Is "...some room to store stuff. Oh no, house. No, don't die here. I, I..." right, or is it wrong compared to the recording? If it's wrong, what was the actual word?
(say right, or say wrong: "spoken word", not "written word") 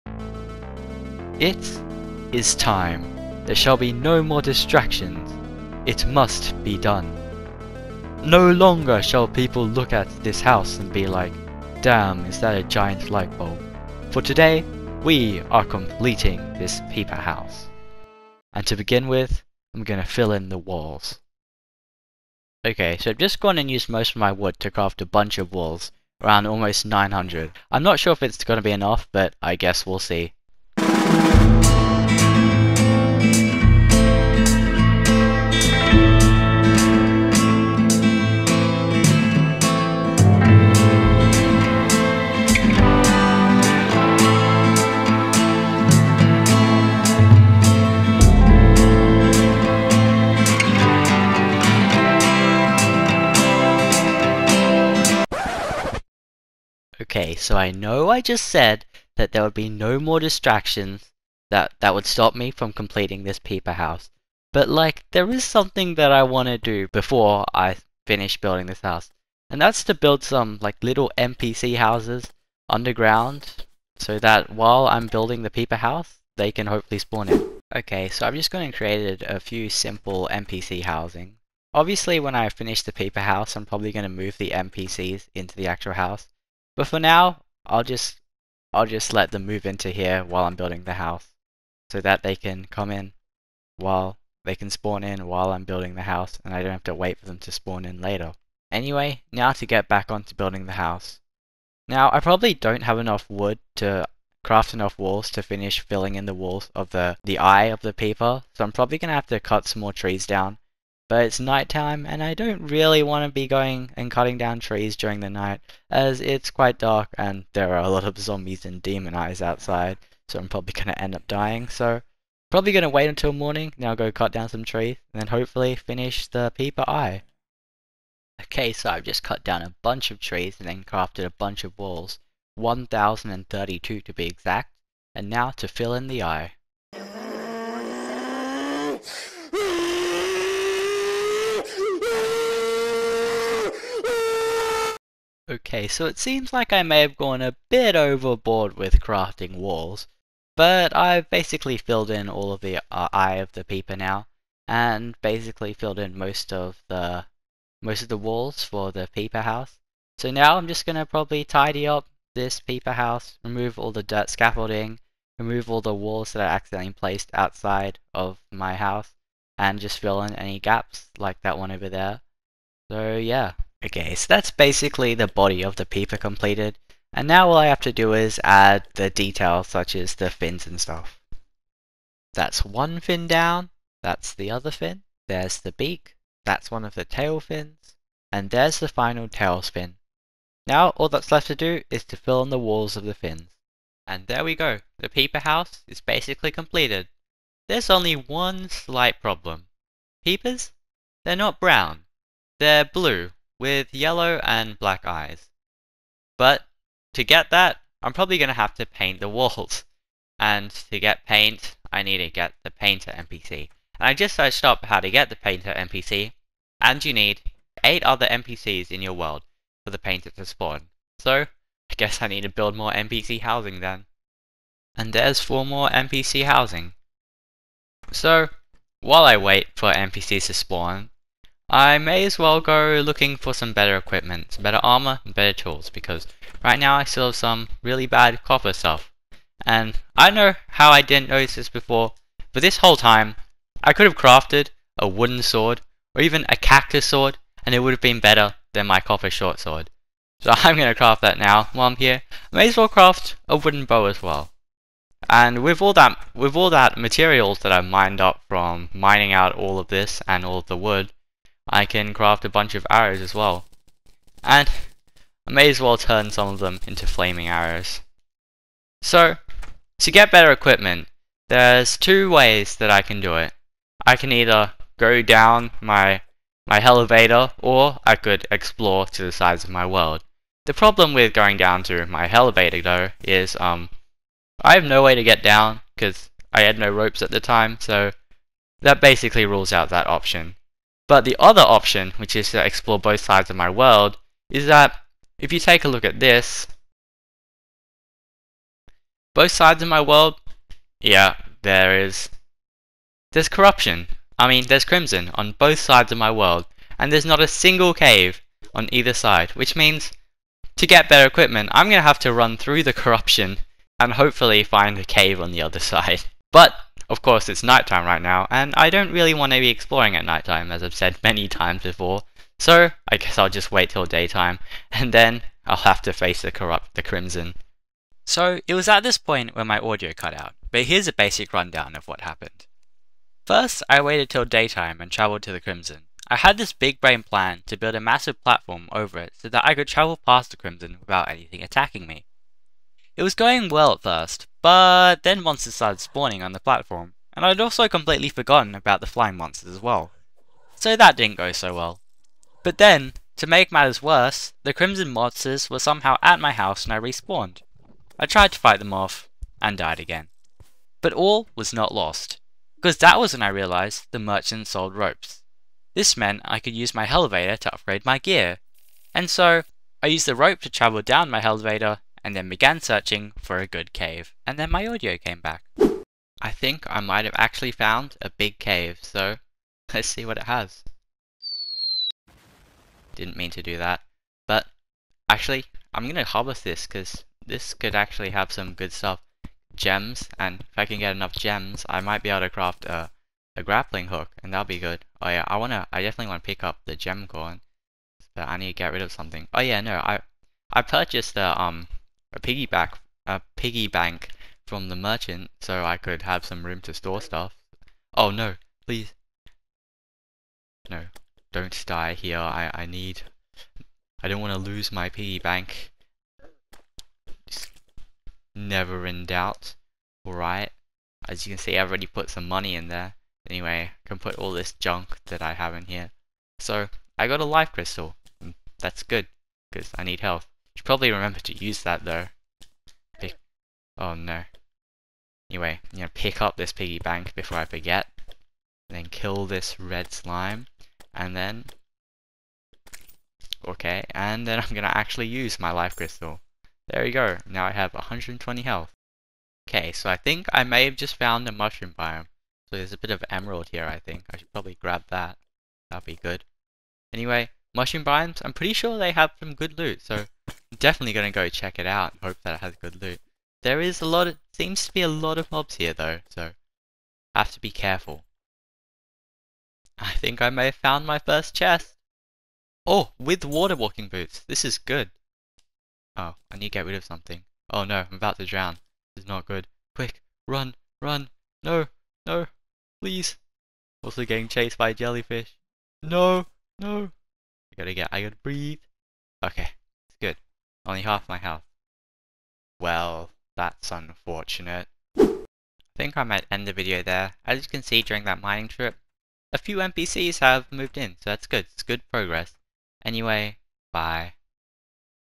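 wrong: "please", not "house".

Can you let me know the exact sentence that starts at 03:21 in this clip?
They're not brown, they're blue with yellow and black eyes.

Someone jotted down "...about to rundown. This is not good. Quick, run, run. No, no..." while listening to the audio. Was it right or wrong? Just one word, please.
wrong.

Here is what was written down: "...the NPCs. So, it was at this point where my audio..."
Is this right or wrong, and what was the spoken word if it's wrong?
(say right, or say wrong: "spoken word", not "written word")
wrong: "Crimson", not "NPCs".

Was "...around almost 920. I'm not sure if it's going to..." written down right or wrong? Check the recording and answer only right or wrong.
wrong.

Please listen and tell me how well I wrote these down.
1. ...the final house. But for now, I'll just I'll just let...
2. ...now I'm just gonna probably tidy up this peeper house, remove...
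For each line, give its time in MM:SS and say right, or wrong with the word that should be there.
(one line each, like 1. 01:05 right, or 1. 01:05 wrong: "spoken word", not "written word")
1. 01:25 wrong: "actual", not "final"
2. 02:40 right.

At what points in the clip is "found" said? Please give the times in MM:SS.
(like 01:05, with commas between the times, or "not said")
06:17, 07:31, 07:50.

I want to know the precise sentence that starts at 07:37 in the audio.
Anyway, mushroom biomes, I'm pretty sure they have some good loot, so definitely going to go check it out.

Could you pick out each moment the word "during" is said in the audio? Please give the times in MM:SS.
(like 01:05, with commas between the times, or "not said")
01:54, 08:18.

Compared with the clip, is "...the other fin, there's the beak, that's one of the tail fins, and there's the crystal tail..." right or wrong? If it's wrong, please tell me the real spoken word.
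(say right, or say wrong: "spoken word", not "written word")
wrong: "final", not "crystal".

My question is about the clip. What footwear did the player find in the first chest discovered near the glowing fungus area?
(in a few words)
water walking boots.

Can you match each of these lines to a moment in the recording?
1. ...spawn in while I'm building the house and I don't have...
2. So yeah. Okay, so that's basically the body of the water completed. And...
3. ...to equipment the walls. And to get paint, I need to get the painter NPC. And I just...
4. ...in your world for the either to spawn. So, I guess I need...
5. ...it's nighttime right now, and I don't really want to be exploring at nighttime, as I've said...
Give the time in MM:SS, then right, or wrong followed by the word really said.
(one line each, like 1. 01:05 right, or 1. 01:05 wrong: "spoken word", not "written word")
1. 01:34 right
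2. 02:52 wrong: "peeper", not "water"
3. 03:28 wrong: "paint", not "equipment"
4. 03:38 wrong: "painter", not "either"
5. 05:17 right.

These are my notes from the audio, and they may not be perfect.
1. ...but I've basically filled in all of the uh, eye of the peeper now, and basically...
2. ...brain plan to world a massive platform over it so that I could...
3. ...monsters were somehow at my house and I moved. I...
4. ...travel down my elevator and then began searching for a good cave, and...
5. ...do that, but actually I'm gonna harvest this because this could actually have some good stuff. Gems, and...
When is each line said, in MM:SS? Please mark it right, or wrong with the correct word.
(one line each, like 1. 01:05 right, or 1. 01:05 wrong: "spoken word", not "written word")
1. 02:30 right
2. 05:37 wrong: "build", not "world"
3. 05:55 wrong: "respawned", not "moved"
4. 06:10 right
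5. 06:23 right.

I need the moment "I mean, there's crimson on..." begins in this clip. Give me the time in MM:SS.
05:04.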